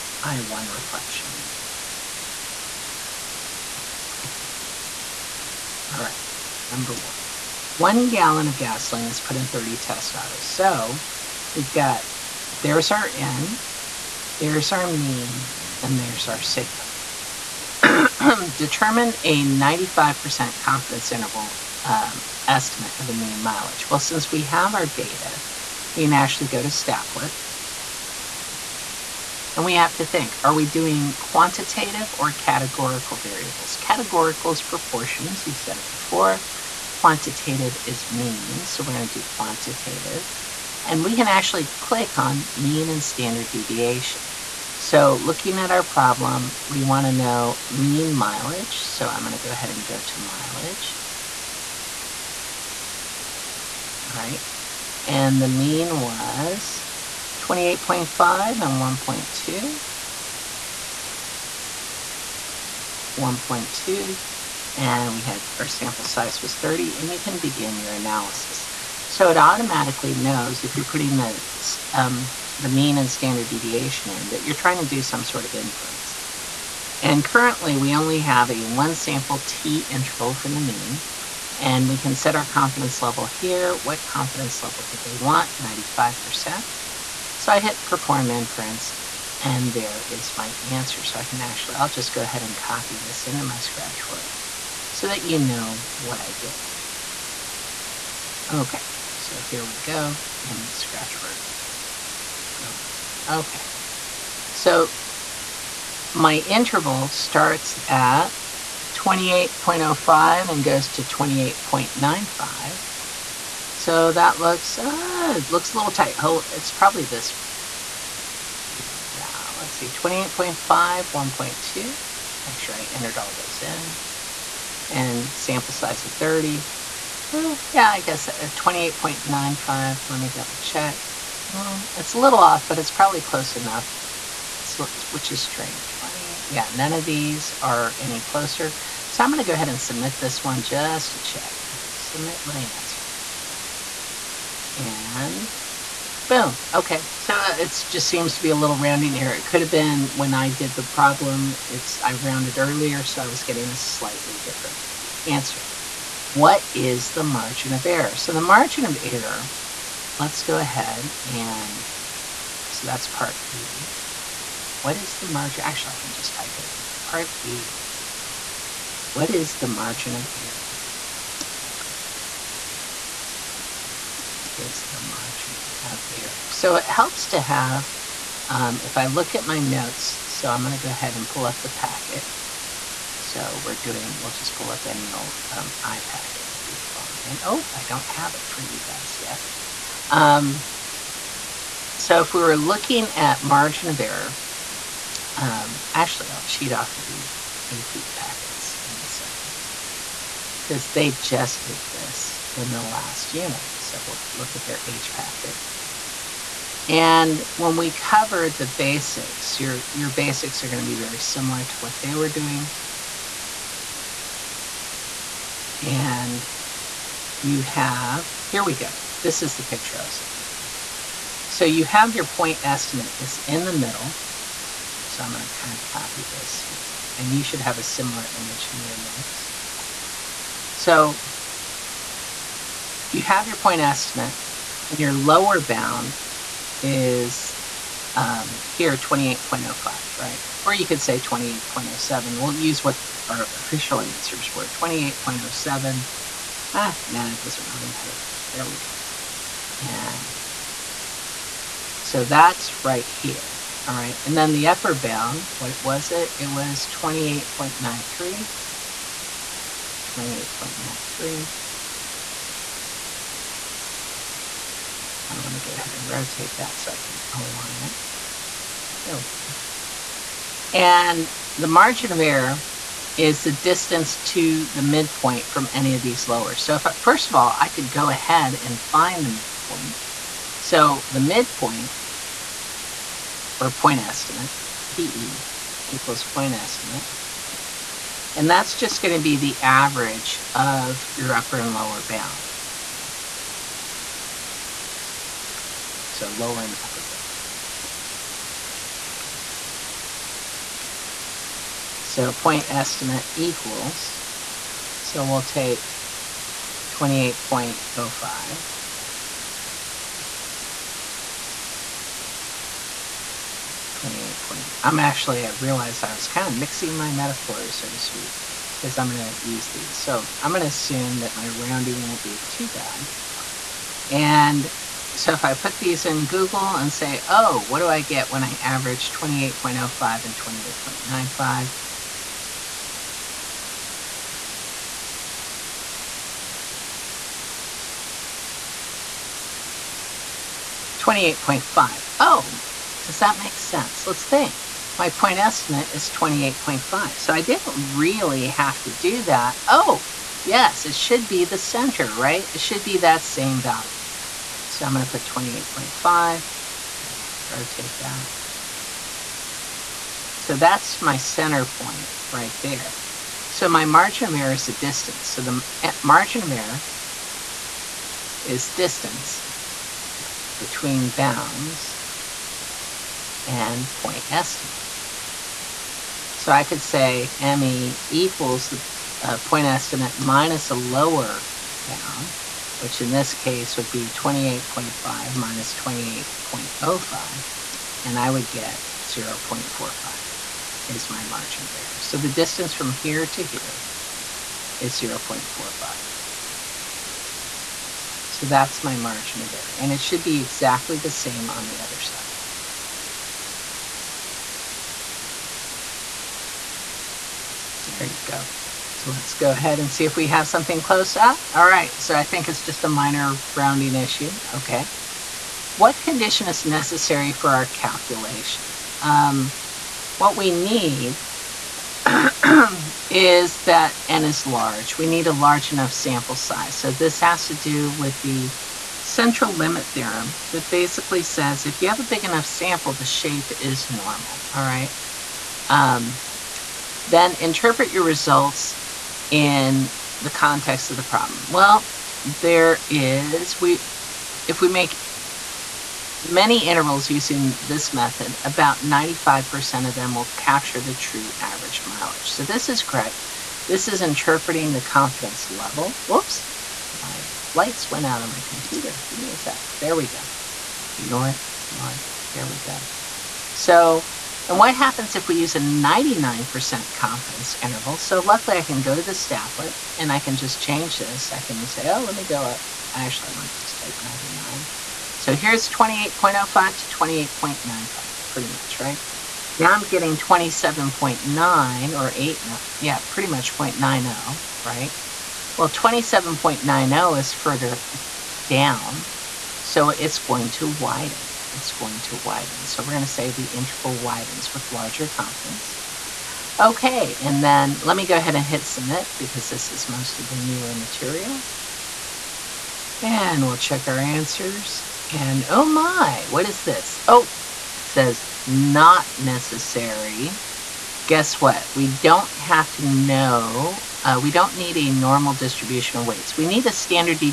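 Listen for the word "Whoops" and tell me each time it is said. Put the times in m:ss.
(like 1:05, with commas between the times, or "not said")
7:36.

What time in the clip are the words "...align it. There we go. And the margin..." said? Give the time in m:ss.
4:27.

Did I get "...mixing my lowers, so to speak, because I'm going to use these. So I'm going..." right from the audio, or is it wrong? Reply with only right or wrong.
wrong.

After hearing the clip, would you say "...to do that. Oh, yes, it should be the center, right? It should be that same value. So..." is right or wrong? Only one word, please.
right.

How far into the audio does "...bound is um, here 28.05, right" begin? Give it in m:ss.
3:55.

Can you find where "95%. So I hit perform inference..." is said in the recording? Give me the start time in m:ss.
1:25.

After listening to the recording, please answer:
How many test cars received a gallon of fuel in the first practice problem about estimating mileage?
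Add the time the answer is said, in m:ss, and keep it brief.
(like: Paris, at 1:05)
30, at 0:09.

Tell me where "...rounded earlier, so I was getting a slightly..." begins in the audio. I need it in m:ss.
2:32.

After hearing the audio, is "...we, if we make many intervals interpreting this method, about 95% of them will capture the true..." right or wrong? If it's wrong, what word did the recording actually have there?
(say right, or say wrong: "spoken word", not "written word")
wrong: "using", not "interpreting".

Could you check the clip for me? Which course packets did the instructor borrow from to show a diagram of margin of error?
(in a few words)
AP packets.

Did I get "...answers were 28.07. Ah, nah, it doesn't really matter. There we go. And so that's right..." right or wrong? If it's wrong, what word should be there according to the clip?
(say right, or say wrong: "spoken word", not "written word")
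right.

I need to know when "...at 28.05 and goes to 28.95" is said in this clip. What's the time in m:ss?
1:47.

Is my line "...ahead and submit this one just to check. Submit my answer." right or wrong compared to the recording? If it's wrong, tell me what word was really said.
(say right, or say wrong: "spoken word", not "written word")
right.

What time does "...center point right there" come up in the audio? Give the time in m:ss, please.
6:01.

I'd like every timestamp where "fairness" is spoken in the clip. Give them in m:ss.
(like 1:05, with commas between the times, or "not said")
not said.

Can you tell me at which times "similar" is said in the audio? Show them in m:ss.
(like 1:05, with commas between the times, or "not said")
3:31, 3:47.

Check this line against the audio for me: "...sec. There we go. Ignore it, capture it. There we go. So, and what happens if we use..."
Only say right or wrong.
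wrong.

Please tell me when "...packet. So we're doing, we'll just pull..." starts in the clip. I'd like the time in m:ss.
3:01.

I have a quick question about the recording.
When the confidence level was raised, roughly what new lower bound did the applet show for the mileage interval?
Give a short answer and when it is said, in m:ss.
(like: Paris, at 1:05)
27.90, at 8:05.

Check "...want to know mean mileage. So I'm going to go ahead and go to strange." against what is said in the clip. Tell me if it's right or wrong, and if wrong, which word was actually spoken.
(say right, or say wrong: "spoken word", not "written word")
wrong: "mileage", not "strange".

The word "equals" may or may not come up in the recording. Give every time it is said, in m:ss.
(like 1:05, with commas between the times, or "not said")
4:45, 5:03, 6:18.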